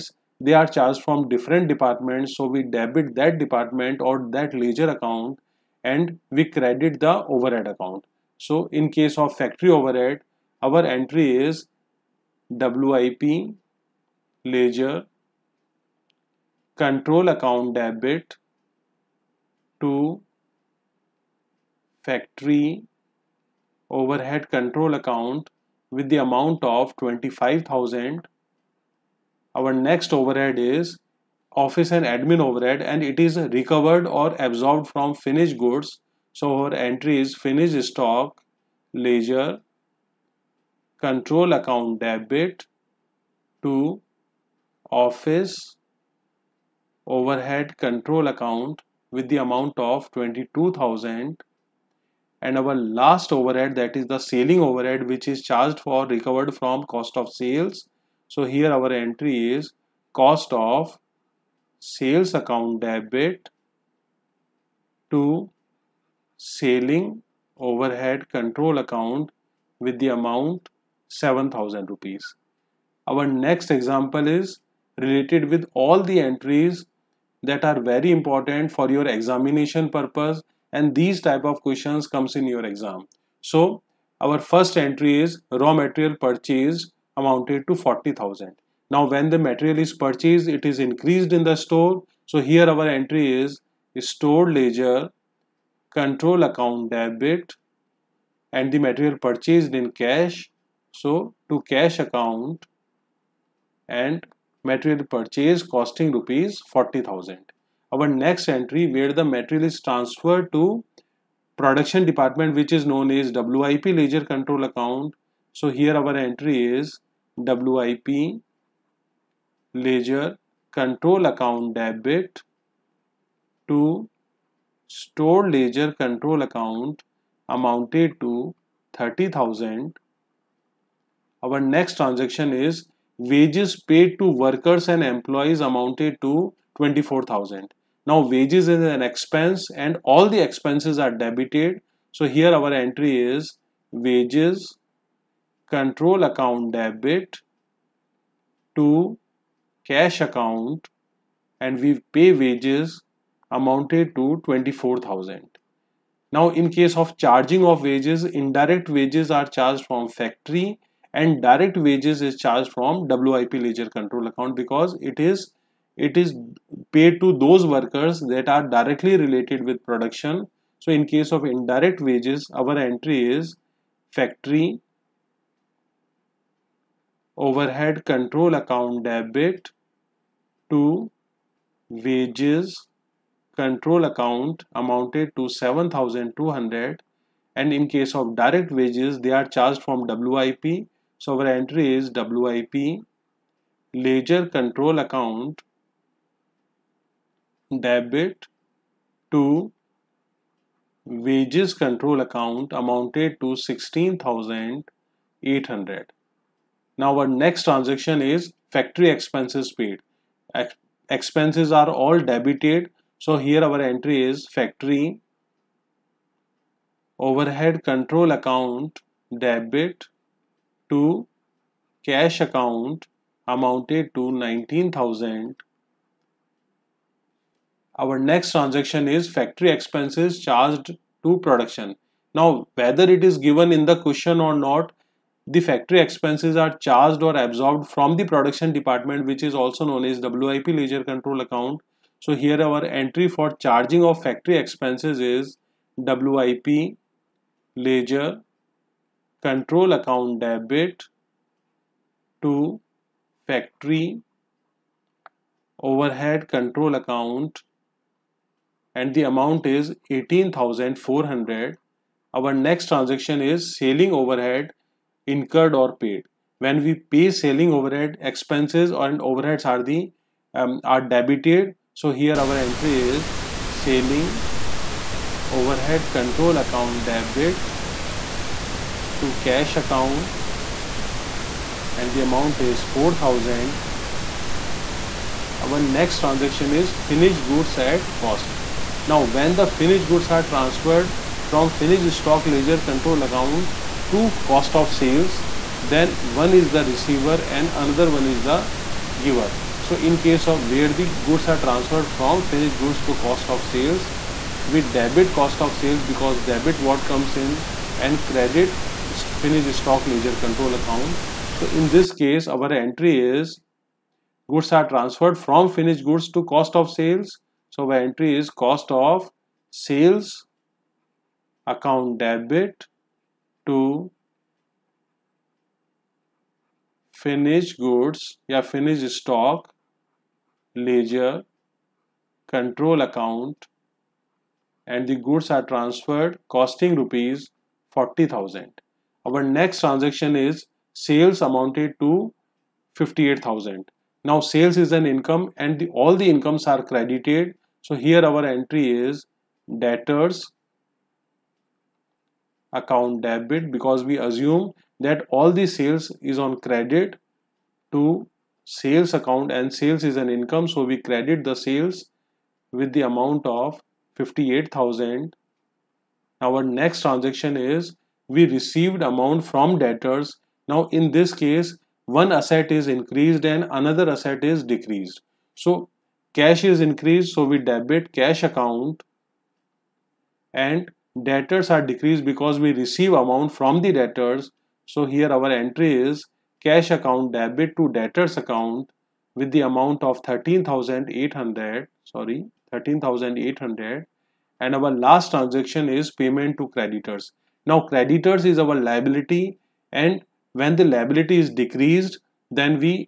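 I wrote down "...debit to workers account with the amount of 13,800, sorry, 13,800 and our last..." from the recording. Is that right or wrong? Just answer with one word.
wrong.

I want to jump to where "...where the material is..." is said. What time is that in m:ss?
1:48.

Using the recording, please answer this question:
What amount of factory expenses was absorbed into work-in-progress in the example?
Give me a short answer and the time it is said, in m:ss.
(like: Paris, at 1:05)
18,400, at 4:20.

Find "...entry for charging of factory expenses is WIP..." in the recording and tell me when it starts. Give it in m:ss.
4:02.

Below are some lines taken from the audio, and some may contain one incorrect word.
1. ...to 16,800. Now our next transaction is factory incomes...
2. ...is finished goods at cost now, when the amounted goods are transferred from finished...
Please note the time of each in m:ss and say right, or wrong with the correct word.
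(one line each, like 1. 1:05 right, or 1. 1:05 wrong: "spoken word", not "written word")
1. 3:23 wrong: "expenses", not "incomes"
2. 4:46 wrong: "finished", not "amounted".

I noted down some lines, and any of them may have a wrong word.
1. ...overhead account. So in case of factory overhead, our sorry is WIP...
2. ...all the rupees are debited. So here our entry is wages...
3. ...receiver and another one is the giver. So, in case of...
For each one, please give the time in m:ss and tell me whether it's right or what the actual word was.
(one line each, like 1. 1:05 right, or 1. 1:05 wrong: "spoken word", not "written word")
1. 0:07 wrong: "entry", not "sorry"
2. 2:20 wrong: "expenses", not "rupees"
3. 4:56 right.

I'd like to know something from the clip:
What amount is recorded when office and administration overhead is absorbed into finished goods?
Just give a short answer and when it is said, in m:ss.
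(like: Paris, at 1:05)
22,000, at 0:50.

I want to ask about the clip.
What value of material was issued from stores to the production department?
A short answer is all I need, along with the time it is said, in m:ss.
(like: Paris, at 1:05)
30,000, at 2:08.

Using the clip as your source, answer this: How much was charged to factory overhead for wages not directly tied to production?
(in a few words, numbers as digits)
7,200.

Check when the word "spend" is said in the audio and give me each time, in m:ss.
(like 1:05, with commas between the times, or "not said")
not said.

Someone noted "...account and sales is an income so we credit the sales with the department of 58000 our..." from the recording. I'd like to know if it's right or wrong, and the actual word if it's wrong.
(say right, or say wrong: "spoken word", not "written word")
wrong: "amount", not "department".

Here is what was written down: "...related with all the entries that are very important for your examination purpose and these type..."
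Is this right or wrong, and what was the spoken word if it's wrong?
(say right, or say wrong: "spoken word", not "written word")
right.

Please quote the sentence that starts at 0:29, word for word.
Our next overhead is office and admin overhead and it is recovered or absorbed from finished goods.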